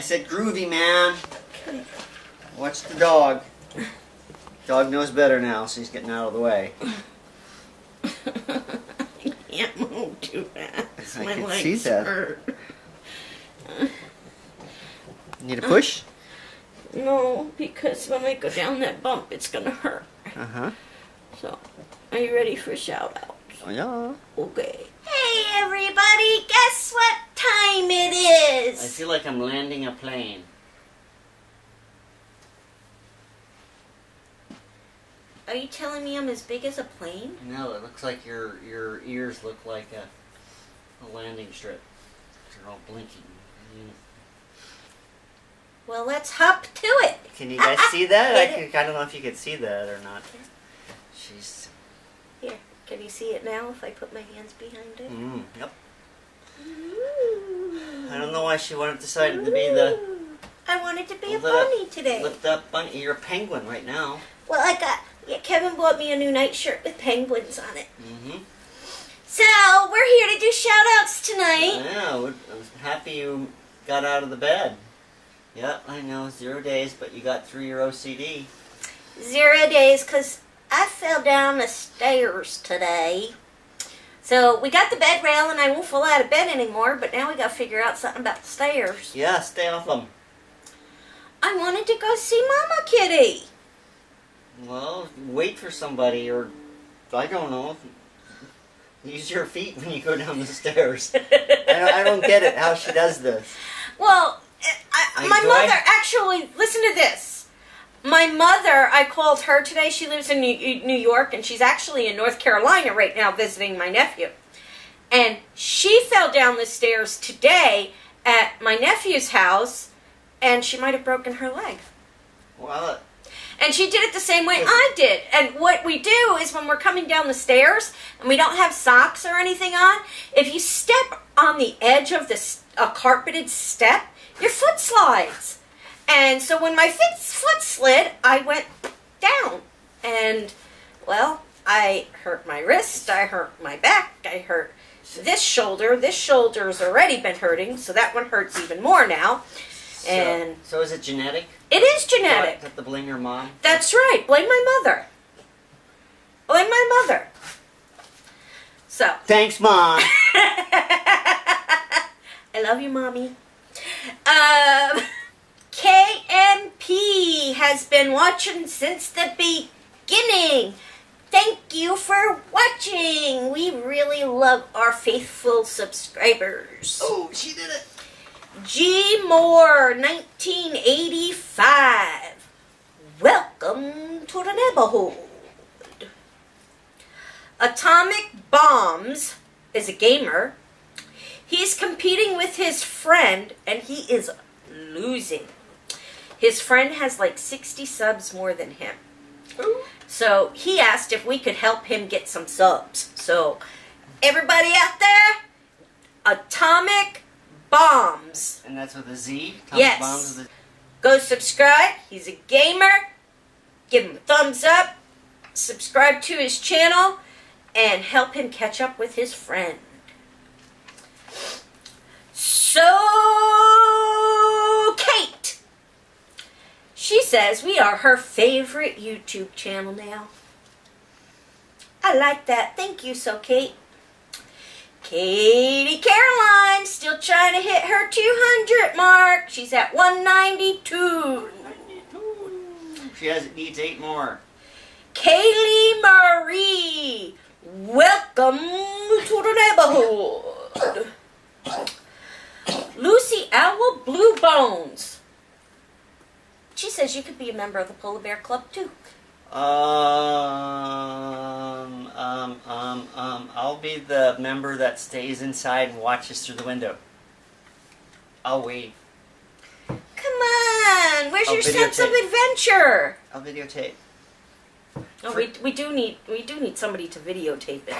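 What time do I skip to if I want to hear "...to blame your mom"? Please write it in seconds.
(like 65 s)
152 s.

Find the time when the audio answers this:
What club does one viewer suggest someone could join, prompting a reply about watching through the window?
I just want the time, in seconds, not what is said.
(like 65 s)
257 s.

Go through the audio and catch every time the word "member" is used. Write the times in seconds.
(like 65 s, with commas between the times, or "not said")
257 s, 264 s.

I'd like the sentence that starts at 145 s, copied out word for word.
This shoulder's already been hurting, so that one hurts even more now.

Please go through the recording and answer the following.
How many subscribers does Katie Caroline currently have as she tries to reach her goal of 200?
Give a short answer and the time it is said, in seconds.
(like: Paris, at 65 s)
192, at 239 s.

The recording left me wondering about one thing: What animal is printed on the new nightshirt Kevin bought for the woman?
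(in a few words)
Penguins.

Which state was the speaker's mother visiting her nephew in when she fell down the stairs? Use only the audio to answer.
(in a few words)
North Carolina.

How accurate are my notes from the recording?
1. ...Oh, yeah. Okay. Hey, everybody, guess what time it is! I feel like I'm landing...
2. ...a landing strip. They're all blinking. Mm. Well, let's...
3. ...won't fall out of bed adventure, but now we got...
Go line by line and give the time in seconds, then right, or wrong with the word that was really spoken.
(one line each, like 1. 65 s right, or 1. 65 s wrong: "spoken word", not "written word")
1. 23 s right
2. 41 s right
3. 85 s wrong: "anymore", not "adventure".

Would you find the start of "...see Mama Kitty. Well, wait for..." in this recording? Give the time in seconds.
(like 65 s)
92 s.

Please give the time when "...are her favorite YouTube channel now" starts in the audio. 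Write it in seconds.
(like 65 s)
227 s.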